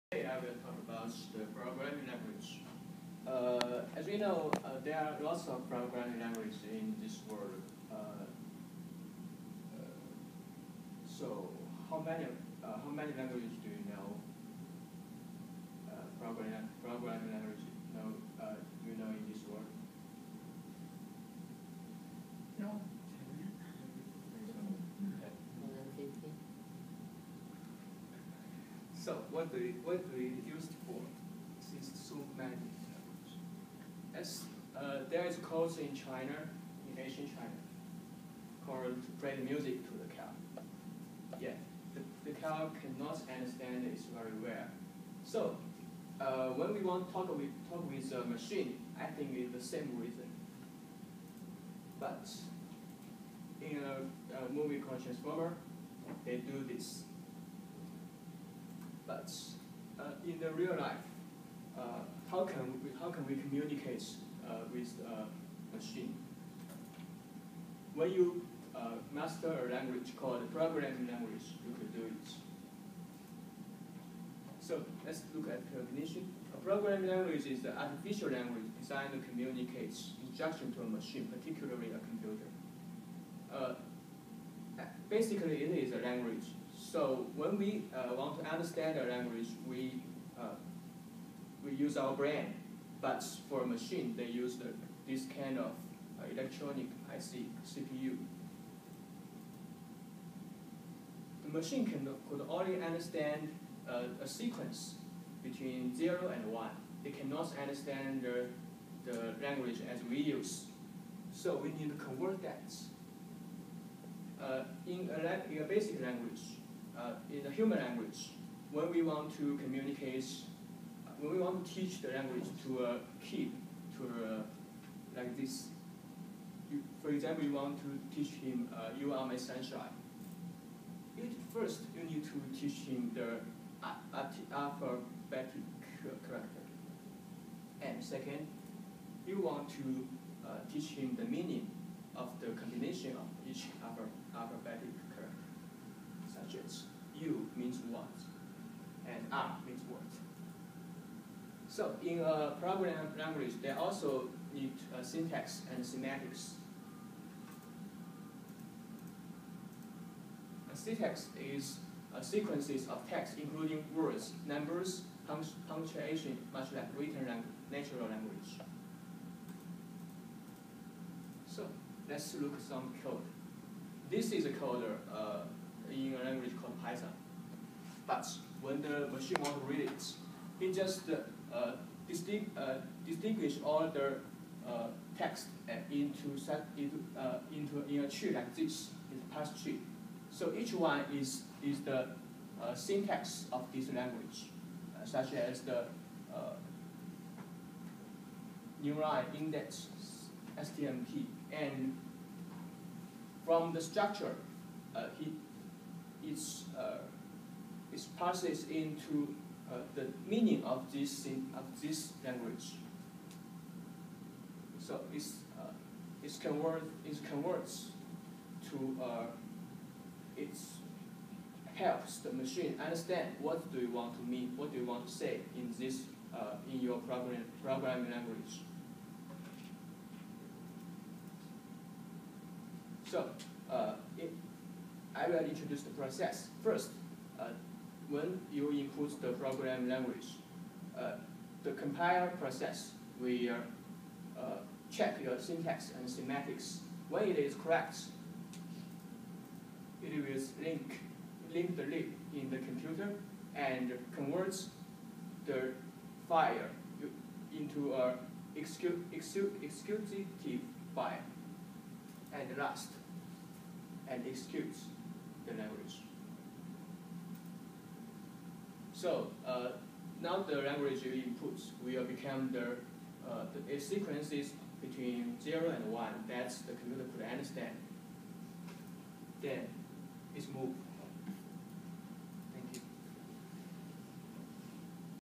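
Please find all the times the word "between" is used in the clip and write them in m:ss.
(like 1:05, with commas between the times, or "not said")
1:45, 4:34.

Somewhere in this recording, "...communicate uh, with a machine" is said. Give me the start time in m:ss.
1:03.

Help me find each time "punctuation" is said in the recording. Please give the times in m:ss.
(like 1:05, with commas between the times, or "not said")
2:45.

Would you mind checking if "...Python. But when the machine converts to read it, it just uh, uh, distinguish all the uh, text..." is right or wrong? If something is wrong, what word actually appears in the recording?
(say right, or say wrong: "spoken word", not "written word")
wrong: "wants", not "converts".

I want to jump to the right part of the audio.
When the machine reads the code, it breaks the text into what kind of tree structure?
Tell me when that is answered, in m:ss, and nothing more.
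3:09.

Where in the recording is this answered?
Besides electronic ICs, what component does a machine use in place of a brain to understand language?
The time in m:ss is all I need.
1:37.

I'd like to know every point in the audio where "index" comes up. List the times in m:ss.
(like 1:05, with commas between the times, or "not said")
3:19.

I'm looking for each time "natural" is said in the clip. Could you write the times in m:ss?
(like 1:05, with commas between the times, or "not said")
2:47.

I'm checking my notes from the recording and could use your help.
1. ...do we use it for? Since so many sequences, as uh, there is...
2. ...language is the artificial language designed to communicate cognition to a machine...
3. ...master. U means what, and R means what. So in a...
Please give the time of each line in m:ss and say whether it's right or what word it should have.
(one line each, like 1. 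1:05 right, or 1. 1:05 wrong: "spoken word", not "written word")
1. 0:30 wrong: "languages", not "sequences"
2. 1:17 wrong: "instruction", not "cognition"
3. 2:25 wrong: "character", not "master".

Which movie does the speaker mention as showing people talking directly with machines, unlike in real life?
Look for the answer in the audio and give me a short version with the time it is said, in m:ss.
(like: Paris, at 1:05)
Transformer, at 0:55.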